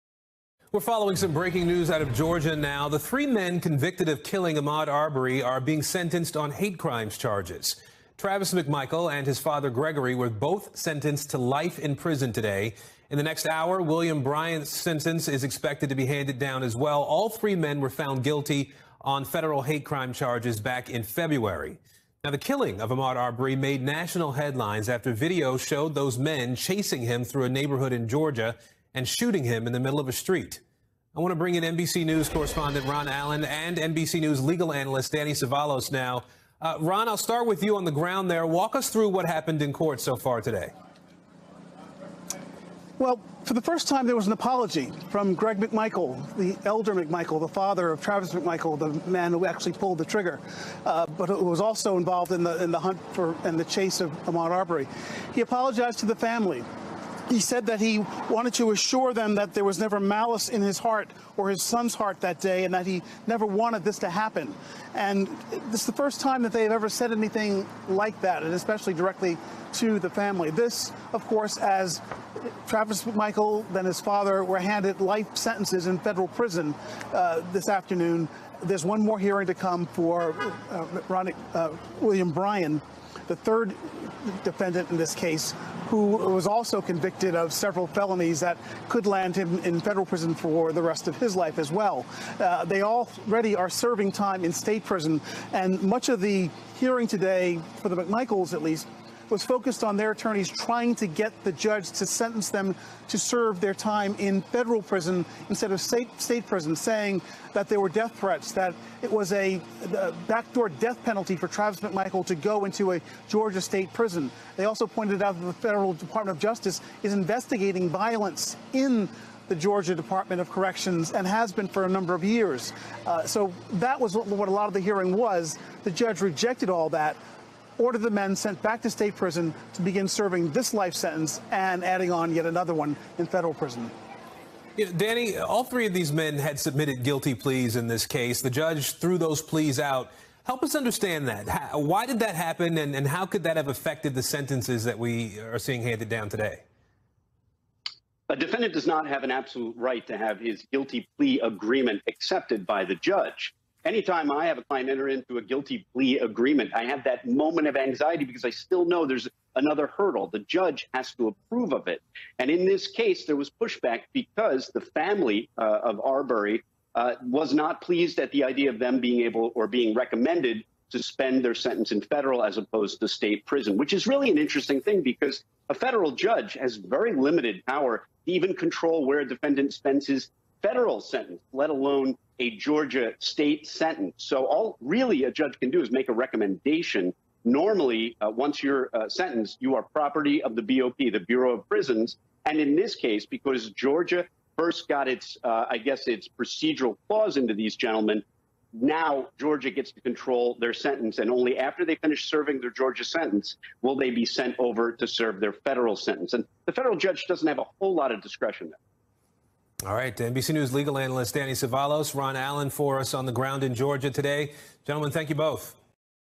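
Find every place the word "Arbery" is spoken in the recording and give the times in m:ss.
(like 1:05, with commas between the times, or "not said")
0:04, 0:23, 0:54, 2:46.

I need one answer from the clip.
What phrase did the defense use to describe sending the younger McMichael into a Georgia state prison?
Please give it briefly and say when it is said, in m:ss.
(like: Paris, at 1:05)
backdoor death penalty, at 1:50.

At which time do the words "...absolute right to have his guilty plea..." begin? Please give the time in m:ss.
2:29.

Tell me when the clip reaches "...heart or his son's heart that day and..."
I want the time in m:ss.
1:00.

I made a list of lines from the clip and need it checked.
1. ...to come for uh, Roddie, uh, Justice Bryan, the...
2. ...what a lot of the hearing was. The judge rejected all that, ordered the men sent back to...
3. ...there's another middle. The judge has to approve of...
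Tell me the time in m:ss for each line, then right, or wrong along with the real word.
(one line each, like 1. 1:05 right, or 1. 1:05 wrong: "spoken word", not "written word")
1. 1:19 wrong: "William", not "Justice"
2. 2:04 right
3. 2:39 wrong: "hurdle", not "middle".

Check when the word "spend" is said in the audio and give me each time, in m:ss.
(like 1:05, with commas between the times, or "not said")
2:51, 2:59.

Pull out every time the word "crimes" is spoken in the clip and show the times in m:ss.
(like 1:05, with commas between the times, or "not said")
0:06, 0:19.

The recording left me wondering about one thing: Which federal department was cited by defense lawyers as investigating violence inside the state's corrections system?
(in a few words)
Department of Justice.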